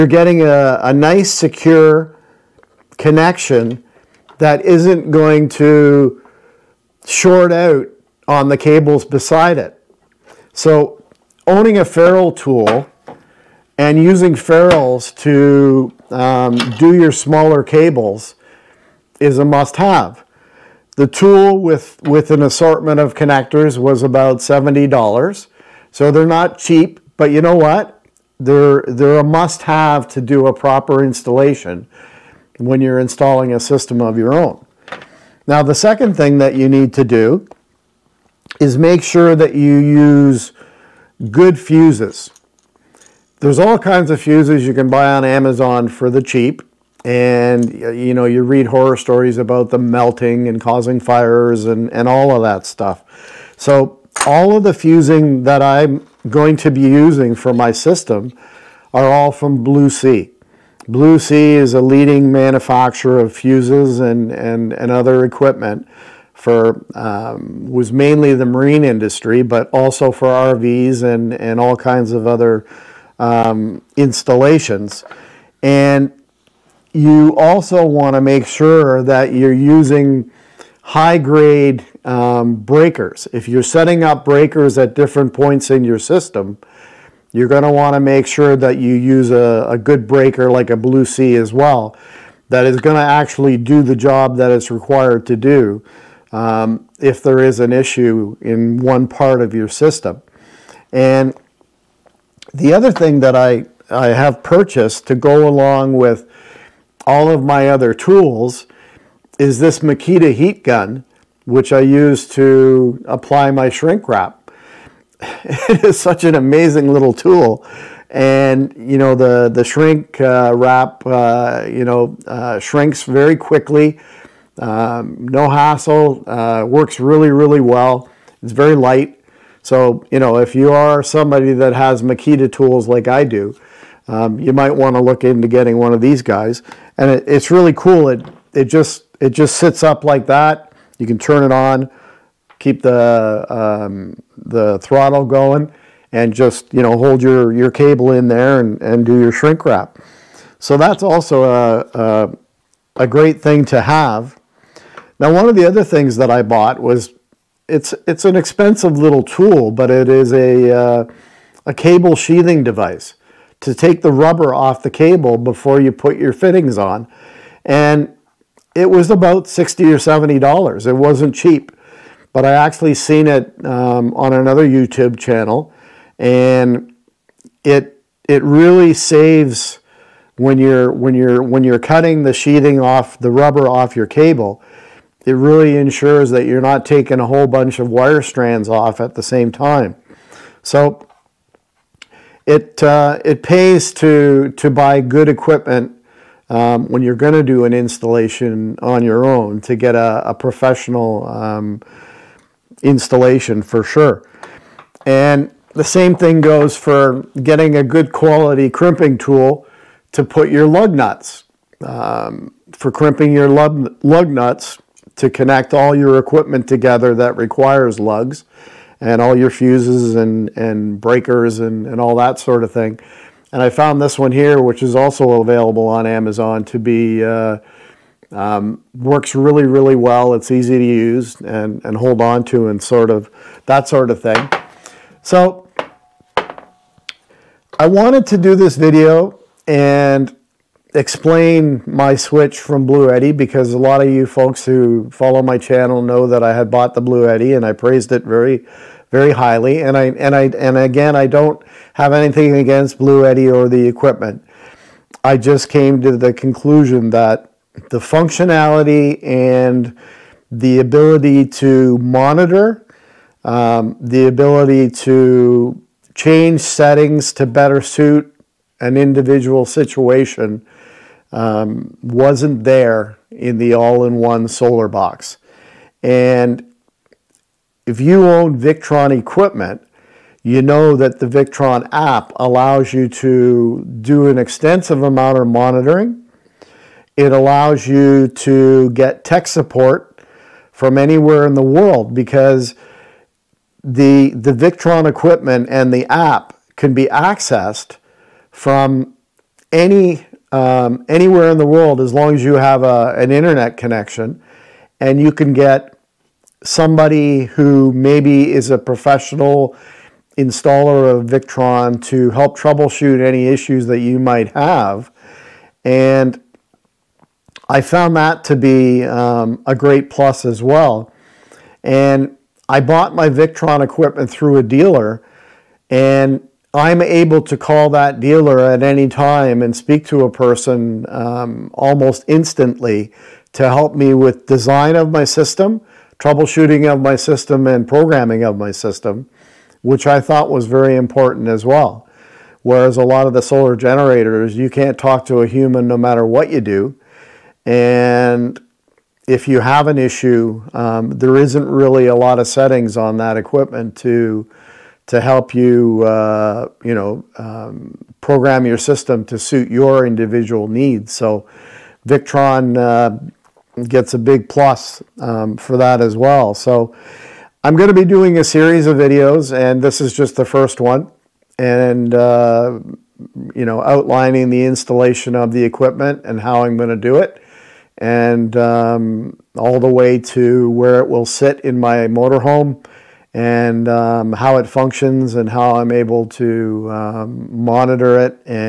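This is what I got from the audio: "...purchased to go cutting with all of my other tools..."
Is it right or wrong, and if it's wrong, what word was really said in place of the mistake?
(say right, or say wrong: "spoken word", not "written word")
wrong: "along", not "cutting".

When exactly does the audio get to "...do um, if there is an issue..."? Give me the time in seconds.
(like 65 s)
95 s.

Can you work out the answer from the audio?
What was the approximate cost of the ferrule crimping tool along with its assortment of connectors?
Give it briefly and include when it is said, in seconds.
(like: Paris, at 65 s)
$70, at 24 s.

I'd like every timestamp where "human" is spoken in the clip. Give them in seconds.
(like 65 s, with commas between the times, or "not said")
345 s.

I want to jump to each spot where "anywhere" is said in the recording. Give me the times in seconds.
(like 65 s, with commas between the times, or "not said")
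290 s, 301 s.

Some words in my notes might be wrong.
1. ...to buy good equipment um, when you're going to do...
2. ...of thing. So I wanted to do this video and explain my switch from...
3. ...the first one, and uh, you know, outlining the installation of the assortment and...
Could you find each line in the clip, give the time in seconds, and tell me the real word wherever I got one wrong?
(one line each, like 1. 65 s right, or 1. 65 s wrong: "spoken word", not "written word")
1. 194 s right
2. 234 s right
3. 370 s wrong: "equipment", not "assortment".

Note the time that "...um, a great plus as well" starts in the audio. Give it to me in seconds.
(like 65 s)
319 s.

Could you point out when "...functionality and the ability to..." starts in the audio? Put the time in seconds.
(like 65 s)
257 s.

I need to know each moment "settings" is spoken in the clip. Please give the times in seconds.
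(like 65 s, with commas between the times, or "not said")
83 s, 266 s, 352 s.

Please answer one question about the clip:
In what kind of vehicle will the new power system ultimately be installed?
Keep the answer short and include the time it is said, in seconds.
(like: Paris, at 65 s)
motorhome, at 381 s.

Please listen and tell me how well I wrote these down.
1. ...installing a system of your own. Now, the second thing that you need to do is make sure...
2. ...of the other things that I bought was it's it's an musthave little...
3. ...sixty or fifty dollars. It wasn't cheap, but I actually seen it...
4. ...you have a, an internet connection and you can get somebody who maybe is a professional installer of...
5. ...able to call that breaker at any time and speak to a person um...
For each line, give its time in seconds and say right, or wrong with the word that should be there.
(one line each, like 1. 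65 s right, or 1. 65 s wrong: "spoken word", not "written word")
1. 32 s right
2. 155 s wrong: "expensive", not "musthave"
3. 169 s wrong: "seventy", not "fifty"
4. 302 s right
5. 327 s wrong: "dealer", not "breaker".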